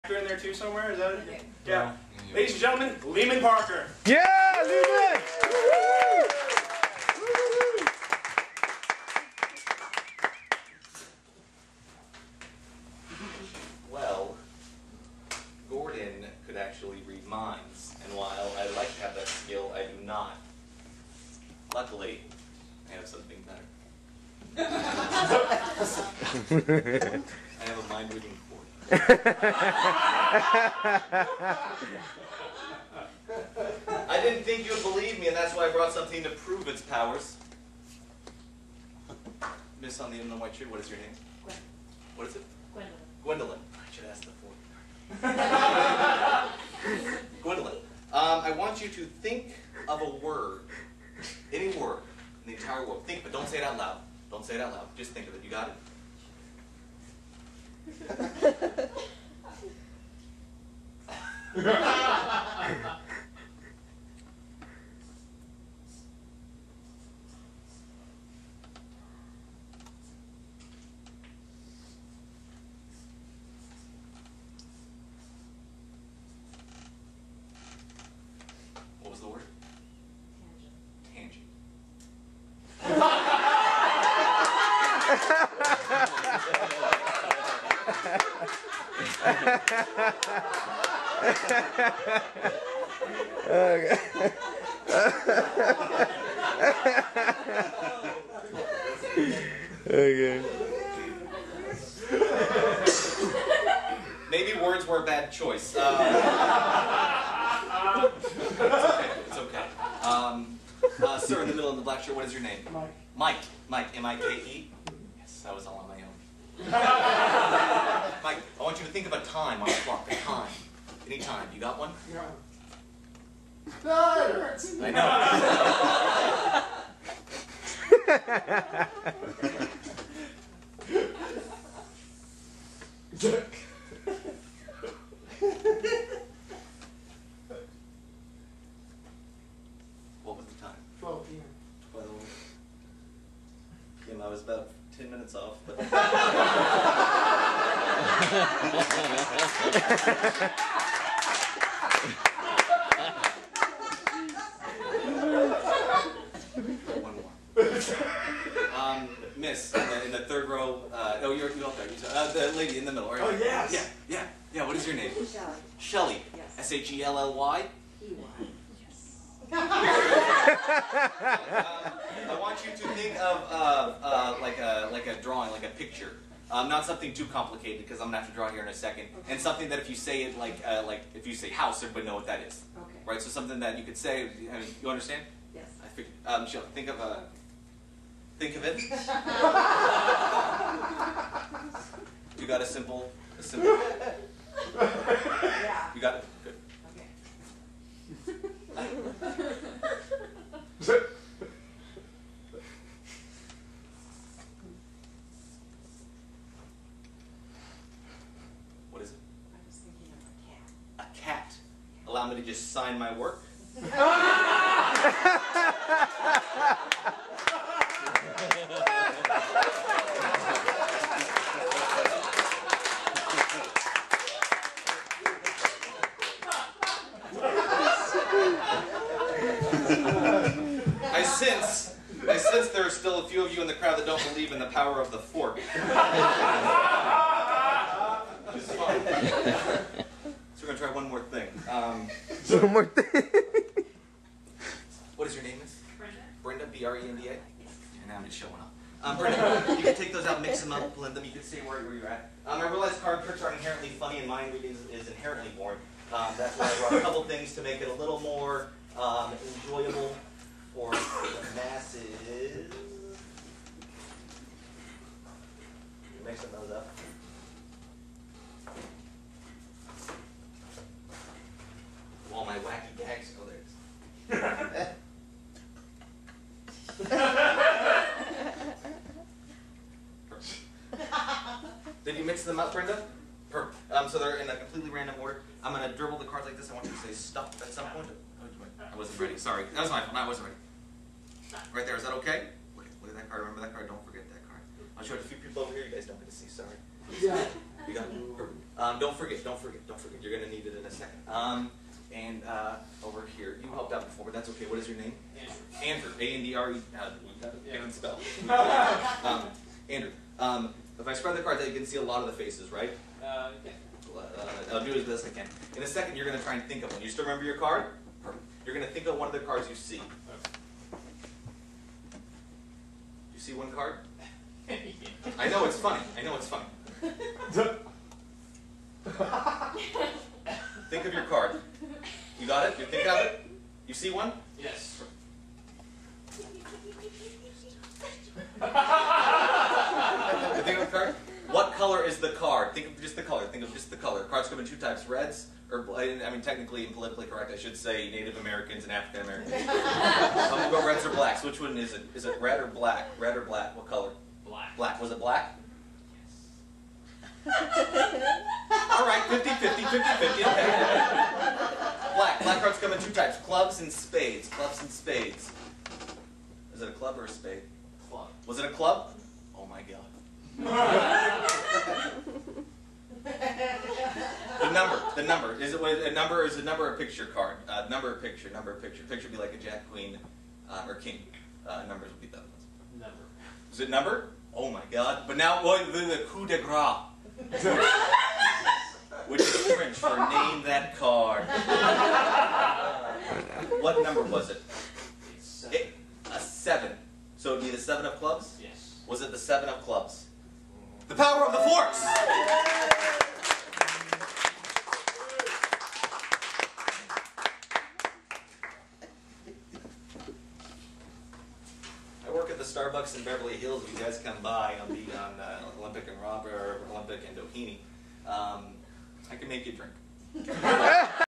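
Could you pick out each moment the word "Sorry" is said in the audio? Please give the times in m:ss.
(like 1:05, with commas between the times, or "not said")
4:49, 4:56.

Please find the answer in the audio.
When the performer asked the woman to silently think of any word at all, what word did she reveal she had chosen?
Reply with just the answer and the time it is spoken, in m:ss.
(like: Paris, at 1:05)
Tangent, at 1:21.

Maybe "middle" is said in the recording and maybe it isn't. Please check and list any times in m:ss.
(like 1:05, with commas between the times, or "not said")
1:51, 2:42.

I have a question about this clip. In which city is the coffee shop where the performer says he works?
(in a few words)
Beverly Hills.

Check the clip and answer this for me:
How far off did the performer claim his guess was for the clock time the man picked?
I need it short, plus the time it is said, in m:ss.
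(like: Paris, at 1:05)
10 minutes, at 2:24.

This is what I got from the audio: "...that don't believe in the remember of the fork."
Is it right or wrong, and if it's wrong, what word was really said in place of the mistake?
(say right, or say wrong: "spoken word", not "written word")
wrong: "power", not "remember".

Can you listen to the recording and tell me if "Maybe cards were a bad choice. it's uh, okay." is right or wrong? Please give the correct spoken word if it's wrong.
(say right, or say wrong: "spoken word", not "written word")
wrong: "words", not "cards".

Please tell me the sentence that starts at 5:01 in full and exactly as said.
Um, and uh, over who helped out before, but that's okay.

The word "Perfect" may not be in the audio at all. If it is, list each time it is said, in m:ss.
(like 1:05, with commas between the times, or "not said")
4:43, 5:18.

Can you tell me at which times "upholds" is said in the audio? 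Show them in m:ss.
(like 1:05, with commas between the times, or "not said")
not said.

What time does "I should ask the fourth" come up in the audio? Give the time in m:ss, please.
0:43.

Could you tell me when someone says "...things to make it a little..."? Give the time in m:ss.
4:17.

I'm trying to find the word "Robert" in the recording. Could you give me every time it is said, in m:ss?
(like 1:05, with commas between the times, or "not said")
6:56.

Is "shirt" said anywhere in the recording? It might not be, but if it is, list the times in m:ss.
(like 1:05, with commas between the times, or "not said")
1:52.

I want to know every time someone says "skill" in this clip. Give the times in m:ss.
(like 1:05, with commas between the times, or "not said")
0:19.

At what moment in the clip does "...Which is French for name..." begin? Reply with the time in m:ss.
6:29.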